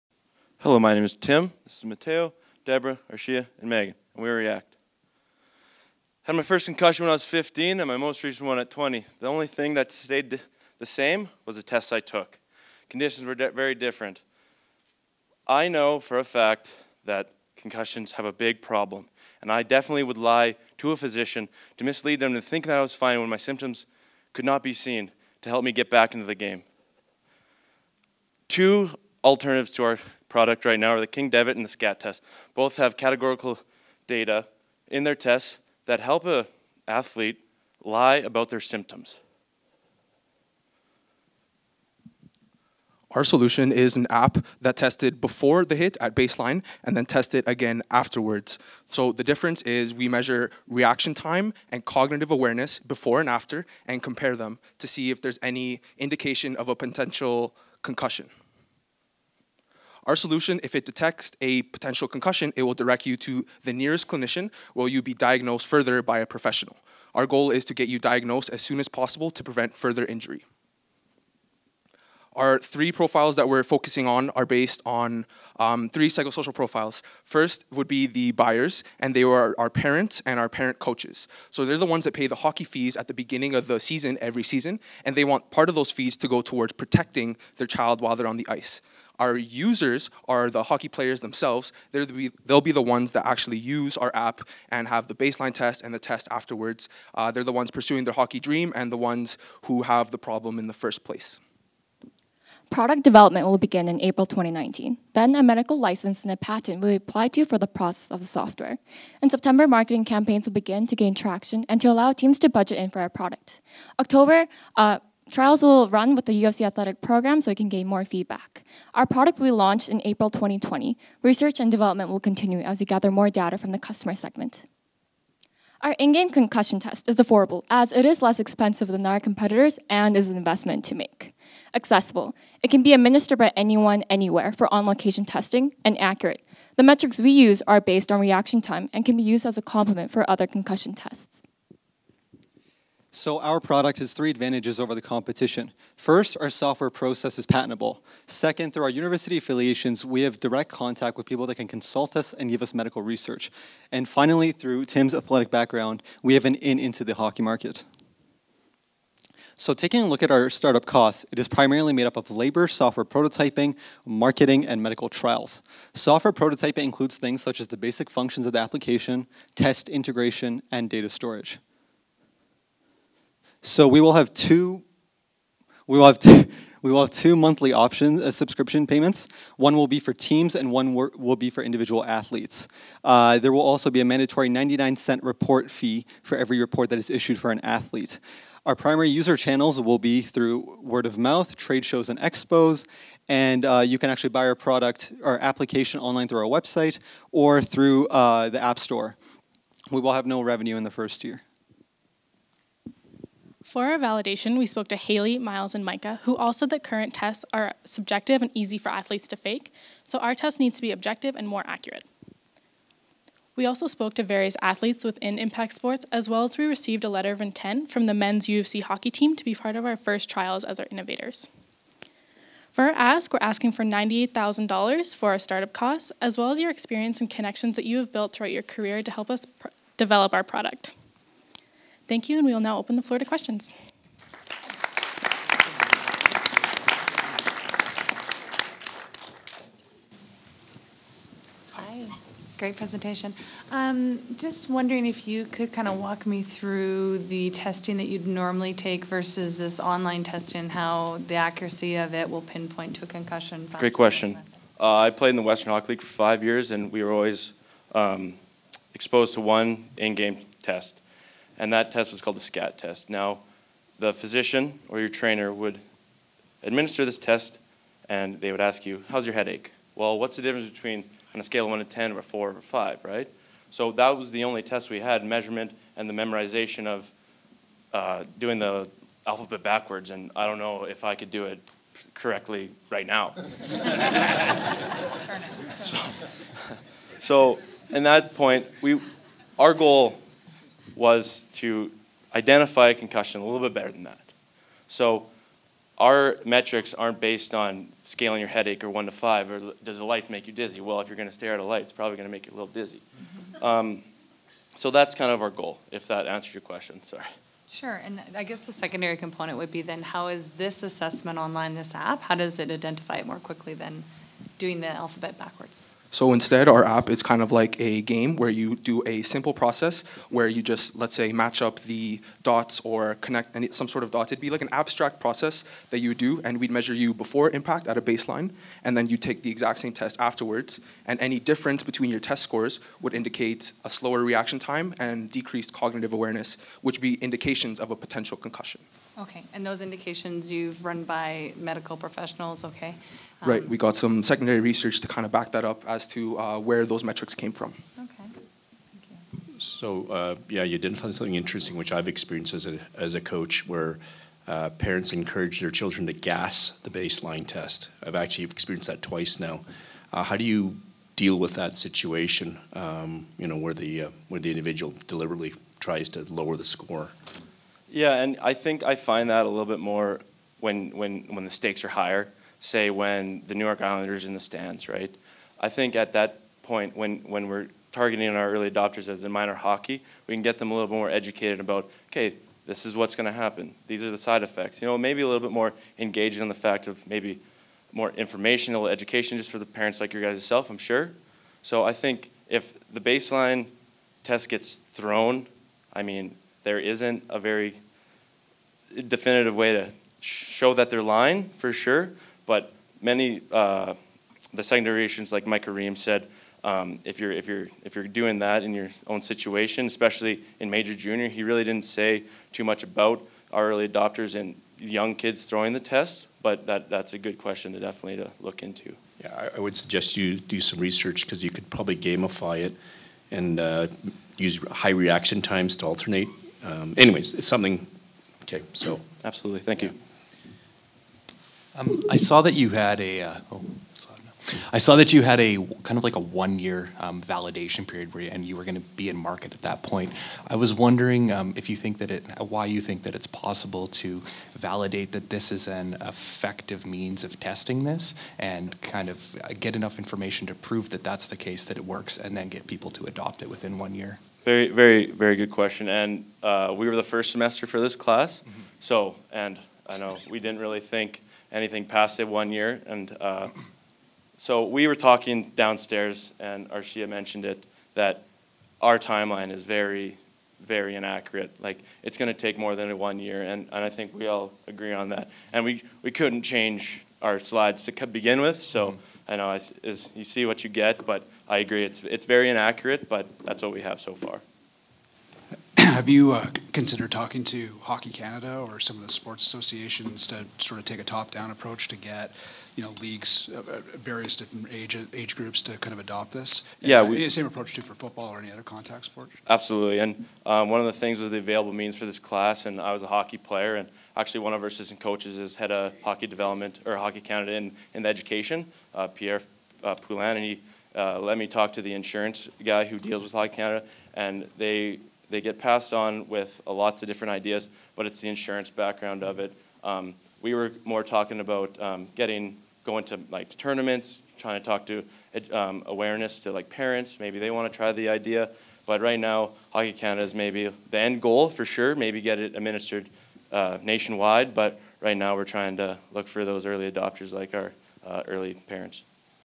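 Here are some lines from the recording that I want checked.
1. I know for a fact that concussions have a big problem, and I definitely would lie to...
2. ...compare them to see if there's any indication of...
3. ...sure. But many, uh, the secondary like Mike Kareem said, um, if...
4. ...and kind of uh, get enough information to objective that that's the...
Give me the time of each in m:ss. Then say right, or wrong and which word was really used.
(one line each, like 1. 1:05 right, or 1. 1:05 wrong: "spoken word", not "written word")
1. 0:15 right
2. 0:54 right
3. 6:41 right
4. 7:28 wrong: "prove", not "objective".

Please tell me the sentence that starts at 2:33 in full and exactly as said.
And finally, through Tim's athletic background, we have an in into the hockey market.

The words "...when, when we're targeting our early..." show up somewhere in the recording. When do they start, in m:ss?
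6:16.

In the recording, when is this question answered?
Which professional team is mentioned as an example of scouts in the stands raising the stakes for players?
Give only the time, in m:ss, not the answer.
6:13.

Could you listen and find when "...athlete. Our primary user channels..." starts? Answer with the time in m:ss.
3:07.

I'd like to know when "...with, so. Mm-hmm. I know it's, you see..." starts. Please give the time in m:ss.
7:58.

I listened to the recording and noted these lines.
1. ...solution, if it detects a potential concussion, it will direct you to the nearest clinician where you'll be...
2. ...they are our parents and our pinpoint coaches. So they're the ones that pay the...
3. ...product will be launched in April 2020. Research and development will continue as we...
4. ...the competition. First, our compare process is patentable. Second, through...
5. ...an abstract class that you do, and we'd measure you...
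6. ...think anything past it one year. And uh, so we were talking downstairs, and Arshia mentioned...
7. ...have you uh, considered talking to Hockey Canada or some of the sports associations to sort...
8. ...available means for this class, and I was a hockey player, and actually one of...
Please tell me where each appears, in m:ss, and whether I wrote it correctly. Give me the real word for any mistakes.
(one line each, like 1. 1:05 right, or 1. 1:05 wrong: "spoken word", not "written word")
1. 1:00 right
2. 1:19 wrong: "parent", not "pinpoint"
3. 1:59 right
4. 2:24 wrong: "software", not "compare"
5. 5:24 wrong: "process", not "class"
6. 7:40 right
7. 8:06 right
8. 8:21 right.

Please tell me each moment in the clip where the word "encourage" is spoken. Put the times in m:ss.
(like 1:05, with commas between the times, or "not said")
5:55.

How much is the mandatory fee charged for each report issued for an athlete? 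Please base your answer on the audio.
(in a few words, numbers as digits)
99 cents.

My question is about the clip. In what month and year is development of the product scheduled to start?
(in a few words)
April 2019.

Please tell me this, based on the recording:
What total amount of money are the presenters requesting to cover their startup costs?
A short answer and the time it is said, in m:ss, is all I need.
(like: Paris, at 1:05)
$98,000, at 3:43.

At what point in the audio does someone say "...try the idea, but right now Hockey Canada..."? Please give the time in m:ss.
8:47.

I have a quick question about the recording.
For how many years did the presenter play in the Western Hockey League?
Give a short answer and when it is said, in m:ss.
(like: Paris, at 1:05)
5, at 4:16.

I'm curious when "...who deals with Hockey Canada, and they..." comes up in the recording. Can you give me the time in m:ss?
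8:32.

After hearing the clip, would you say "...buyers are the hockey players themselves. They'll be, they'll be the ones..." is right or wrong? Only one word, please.
wrong.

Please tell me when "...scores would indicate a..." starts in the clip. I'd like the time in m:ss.
5:32.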